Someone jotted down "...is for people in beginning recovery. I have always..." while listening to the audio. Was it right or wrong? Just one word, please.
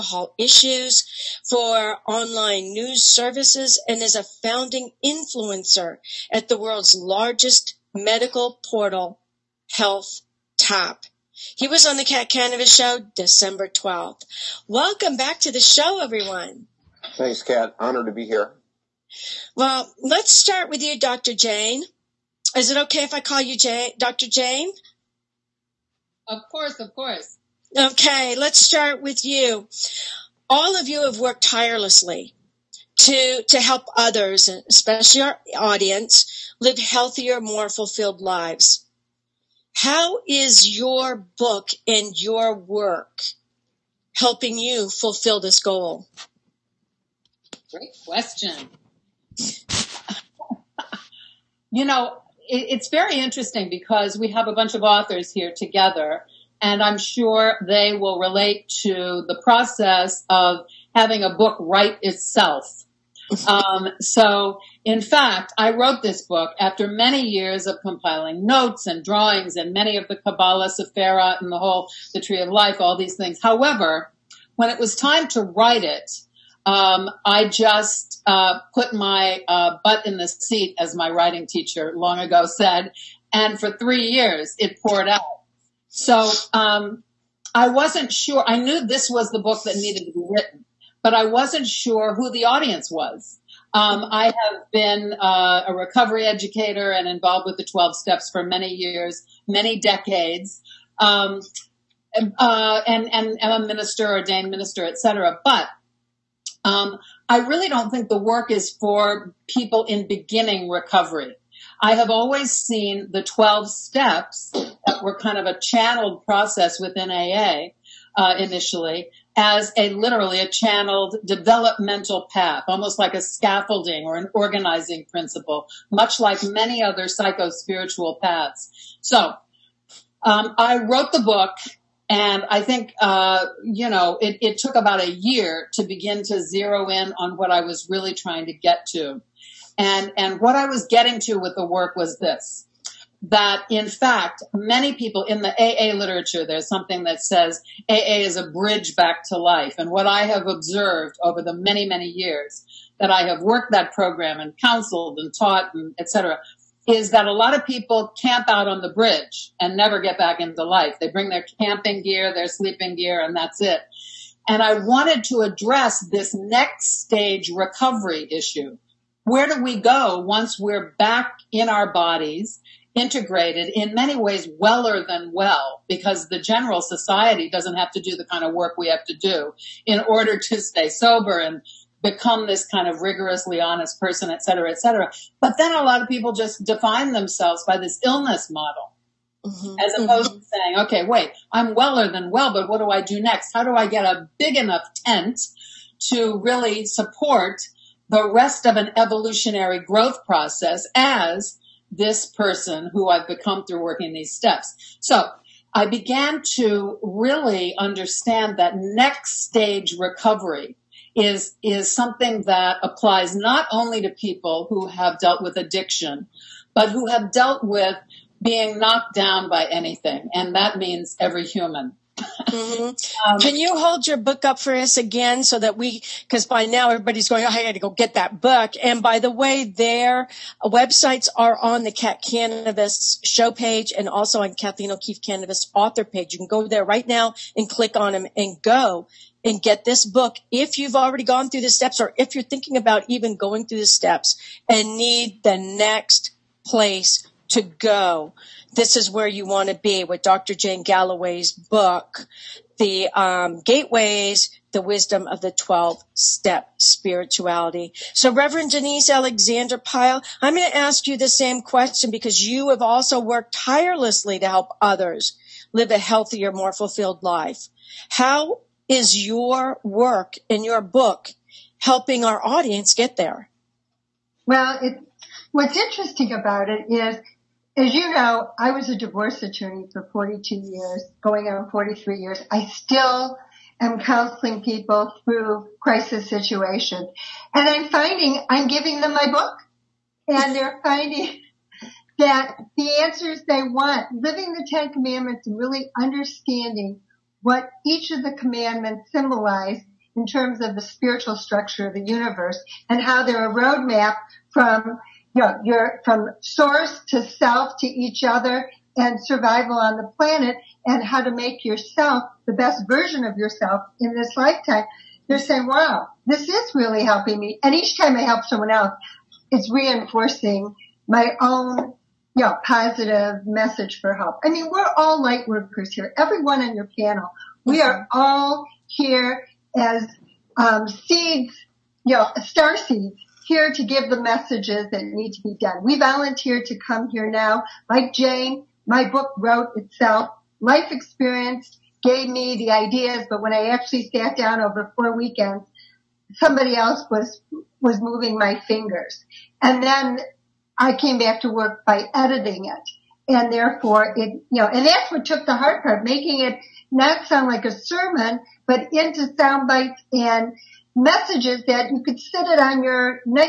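right.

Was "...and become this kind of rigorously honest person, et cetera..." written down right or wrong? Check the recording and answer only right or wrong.
right.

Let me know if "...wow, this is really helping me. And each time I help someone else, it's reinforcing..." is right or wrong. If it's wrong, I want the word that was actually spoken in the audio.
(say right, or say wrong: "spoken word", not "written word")
right.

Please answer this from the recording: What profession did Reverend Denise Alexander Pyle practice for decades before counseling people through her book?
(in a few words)
divorce attorney.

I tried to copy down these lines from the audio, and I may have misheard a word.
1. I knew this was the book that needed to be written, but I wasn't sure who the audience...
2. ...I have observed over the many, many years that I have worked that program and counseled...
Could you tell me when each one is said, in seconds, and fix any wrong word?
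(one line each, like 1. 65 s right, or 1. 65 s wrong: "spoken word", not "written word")
1. 88 s right
2. 150 s right.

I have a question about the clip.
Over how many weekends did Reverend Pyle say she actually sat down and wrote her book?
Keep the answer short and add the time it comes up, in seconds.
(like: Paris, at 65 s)
4, at 344 s.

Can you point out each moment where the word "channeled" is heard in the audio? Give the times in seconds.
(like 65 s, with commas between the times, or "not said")
115 s, 120 s.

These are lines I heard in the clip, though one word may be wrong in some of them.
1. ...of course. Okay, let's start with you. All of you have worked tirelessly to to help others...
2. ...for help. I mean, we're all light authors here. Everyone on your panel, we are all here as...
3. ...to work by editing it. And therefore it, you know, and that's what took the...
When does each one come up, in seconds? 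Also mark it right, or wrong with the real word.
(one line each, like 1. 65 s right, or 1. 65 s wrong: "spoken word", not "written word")
1. 26 s right
2. 323 s wrong: "workers", not "authors"
3. 351 s right.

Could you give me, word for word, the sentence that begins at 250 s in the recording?
Jane Galloway's book, The um, Gateways, The Wisdom of the 12 Step Spirituality.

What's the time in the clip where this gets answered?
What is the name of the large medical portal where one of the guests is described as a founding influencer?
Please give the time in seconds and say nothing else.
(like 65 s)
9 s.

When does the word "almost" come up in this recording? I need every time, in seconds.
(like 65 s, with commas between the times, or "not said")
122 s.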